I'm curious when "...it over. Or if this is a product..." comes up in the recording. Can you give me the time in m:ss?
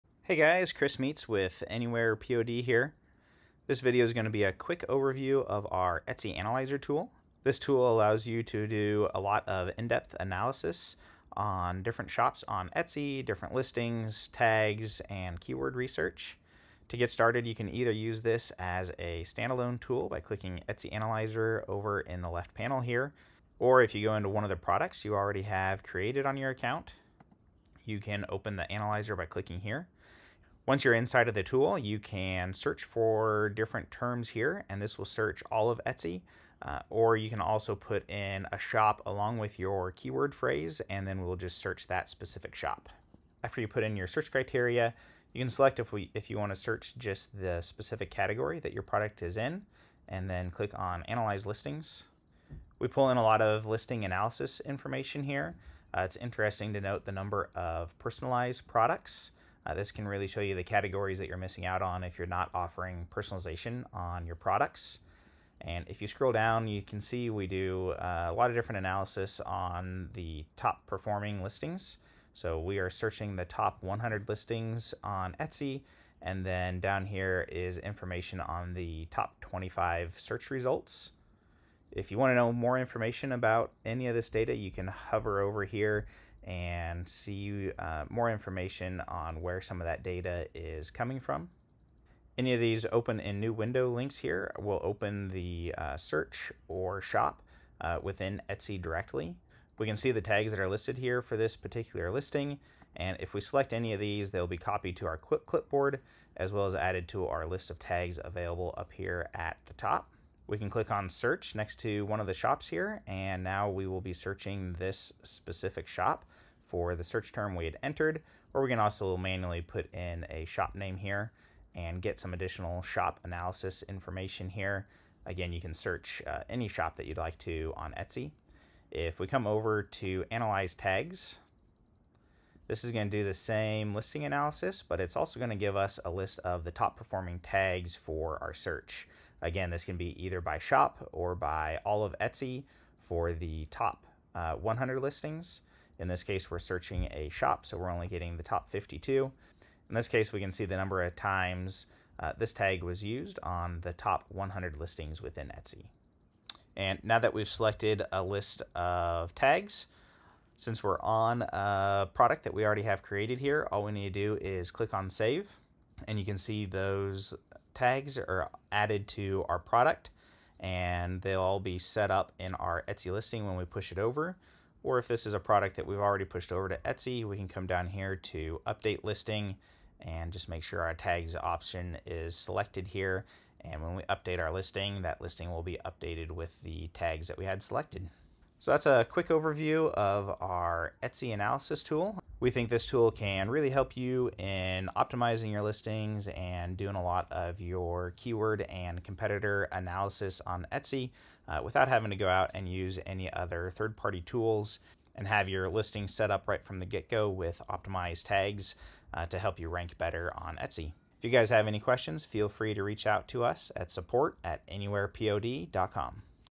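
2:53.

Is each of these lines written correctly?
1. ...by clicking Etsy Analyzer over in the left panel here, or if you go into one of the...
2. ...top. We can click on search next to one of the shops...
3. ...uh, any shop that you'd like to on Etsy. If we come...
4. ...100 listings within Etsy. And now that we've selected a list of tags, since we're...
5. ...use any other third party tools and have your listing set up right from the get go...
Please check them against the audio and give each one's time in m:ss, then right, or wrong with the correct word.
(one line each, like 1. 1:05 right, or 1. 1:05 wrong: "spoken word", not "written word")
1. 0:20 right
2. 1:49 right
3. 2:06 right
4. 2:34 right
5. 3:22 right.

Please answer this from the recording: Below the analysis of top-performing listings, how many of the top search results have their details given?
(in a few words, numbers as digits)
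25.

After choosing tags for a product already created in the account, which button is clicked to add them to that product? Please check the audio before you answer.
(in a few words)
Save.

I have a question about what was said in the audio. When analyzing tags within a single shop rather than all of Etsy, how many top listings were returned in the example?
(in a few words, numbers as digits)
52.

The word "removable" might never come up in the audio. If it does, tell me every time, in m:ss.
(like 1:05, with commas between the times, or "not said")
not said.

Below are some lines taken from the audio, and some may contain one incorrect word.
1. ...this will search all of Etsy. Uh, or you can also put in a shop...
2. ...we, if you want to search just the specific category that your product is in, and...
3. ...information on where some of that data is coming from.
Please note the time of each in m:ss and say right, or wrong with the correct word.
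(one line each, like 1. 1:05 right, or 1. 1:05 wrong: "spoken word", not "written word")
1. 0:34 right
2. 0:45 right
3. 1:28 right.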